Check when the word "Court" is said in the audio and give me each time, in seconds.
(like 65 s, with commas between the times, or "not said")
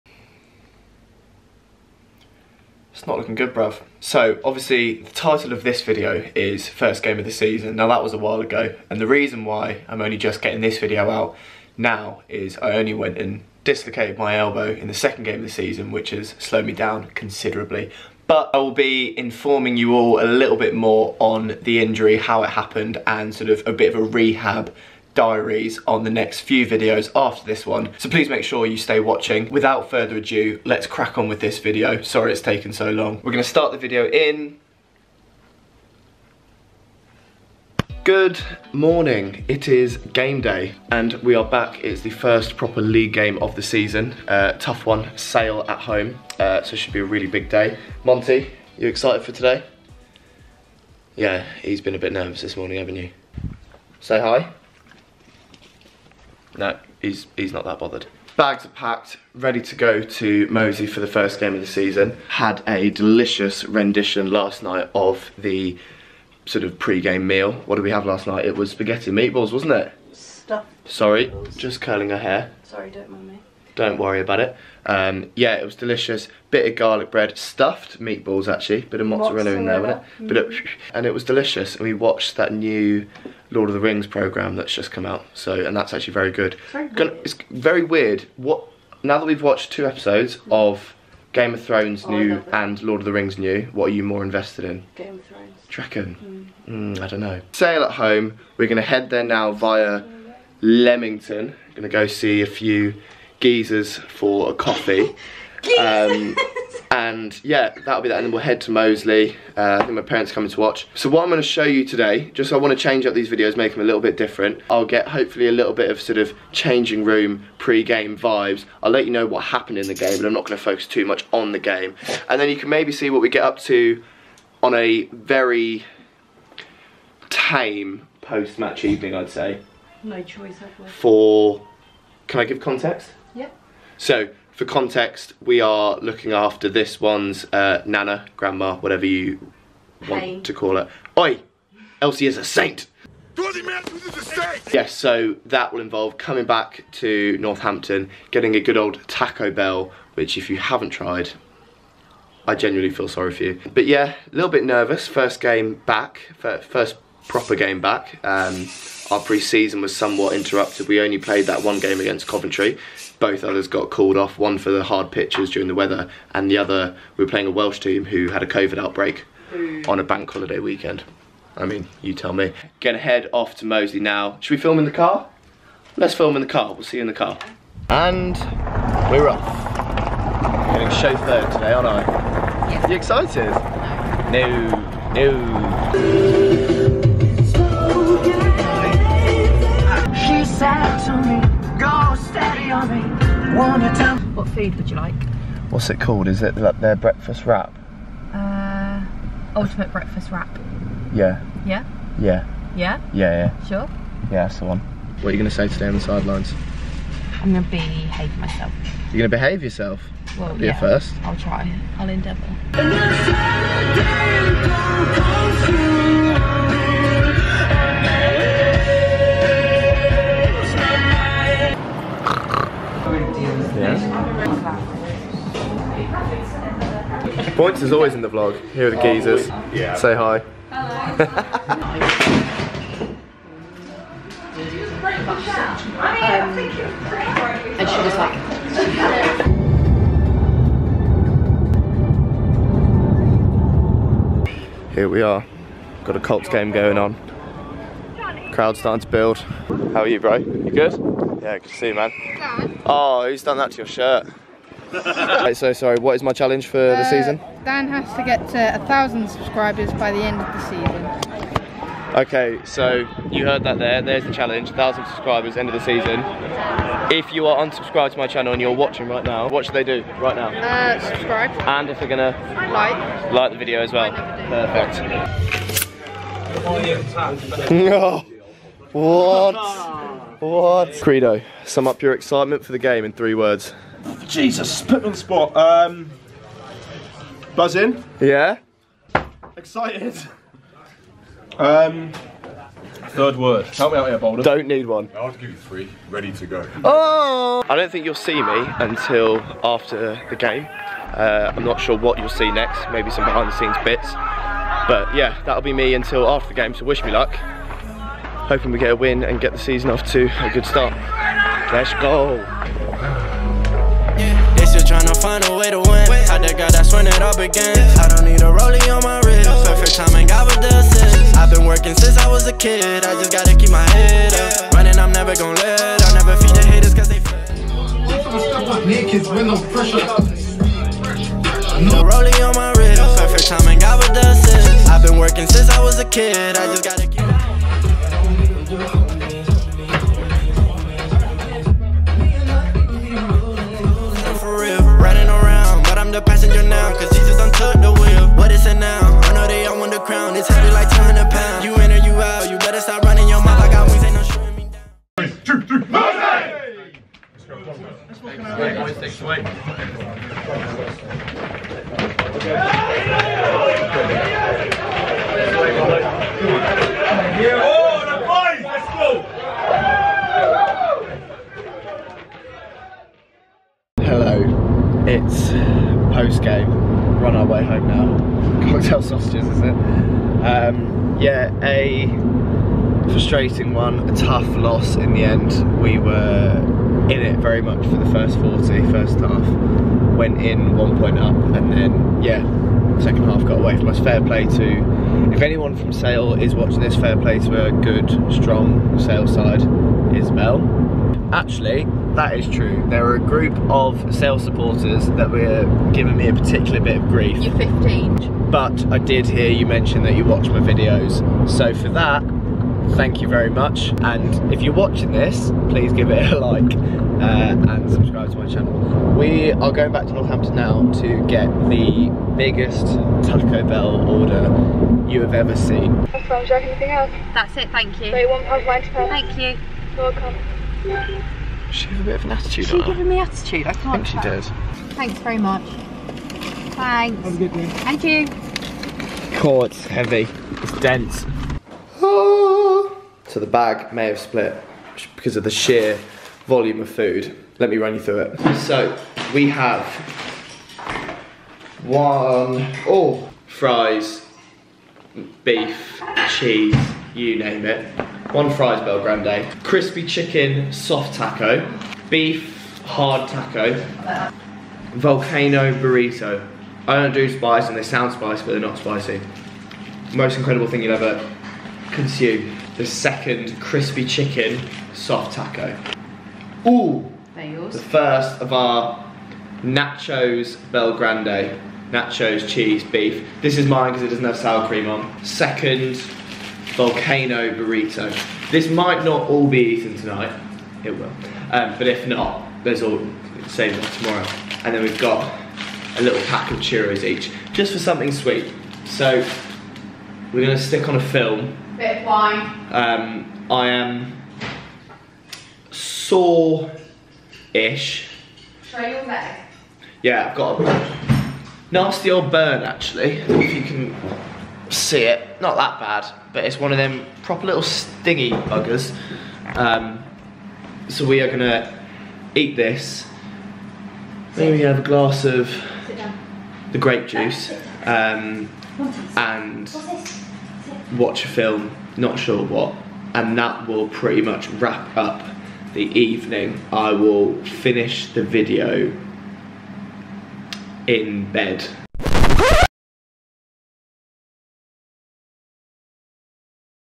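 439 s.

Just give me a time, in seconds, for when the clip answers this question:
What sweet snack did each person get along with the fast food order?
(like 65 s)
496 s.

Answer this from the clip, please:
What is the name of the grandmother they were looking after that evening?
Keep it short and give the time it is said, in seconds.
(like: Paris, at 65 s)
Elsie, at 142 s.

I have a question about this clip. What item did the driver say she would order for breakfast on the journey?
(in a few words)
Ultimate breakfast wrap.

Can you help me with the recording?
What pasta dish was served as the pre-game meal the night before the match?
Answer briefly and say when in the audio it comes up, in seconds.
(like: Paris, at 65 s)
Spaghetti meatballs, at 68 s.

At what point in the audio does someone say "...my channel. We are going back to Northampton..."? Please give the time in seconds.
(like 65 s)
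418 s.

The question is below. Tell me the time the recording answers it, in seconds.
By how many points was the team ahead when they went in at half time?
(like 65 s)
390 s.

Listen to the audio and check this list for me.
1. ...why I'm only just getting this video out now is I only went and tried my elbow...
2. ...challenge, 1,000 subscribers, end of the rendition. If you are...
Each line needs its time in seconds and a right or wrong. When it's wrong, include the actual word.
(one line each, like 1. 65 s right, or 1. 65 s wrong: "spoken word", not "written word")
1. 9 s wrong: "dislocated", not "tried"
2. 264 s wrong: "season", not "rendition".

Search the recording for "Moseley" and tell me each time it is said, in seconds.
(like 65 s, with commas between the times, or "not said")
60 s, 108 s, 173 s.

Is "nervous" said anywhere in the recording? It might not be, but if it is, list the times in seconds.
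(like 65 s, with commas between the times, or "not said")
52 s, 154 s.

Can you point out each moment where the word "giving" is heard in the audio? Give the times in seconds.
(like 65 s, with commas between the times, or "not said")
405 s, 432 s.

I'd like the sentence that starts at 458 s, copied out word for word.
One fries BellGrande, crispy chicken soft taco, beef hard taco, volcano burrito.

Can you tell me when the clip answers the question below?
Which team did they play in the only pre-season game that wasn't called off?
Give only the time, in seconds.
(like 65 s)
162 s.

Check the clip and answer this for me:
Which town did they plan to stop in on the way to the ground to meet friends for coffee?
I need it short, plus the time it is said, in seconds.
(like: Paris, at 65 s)
Leamington, at 100 s.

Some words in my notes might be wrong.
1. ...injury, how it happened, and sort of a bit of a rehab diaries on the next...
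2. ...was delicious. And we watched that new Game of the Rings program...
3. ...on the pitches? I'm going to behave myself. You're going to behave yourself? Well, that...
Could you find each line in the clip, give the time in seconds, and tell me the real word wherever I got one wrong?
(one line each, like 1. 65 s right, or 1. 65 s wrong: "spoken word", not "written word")
1. 21 s right
2. 81 s wrong: "Lord", not "Game"
3. 205 s wrong: "sidelines", not "pitches".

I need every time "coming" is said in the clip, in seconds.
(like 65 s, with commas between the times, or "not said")
110 s, 146 s.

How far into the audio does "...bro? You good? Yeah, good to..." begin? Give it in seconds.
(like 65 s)
250 s.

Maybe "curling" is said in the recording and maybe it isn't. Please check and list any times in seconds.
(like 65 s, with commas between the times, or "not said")
71 s.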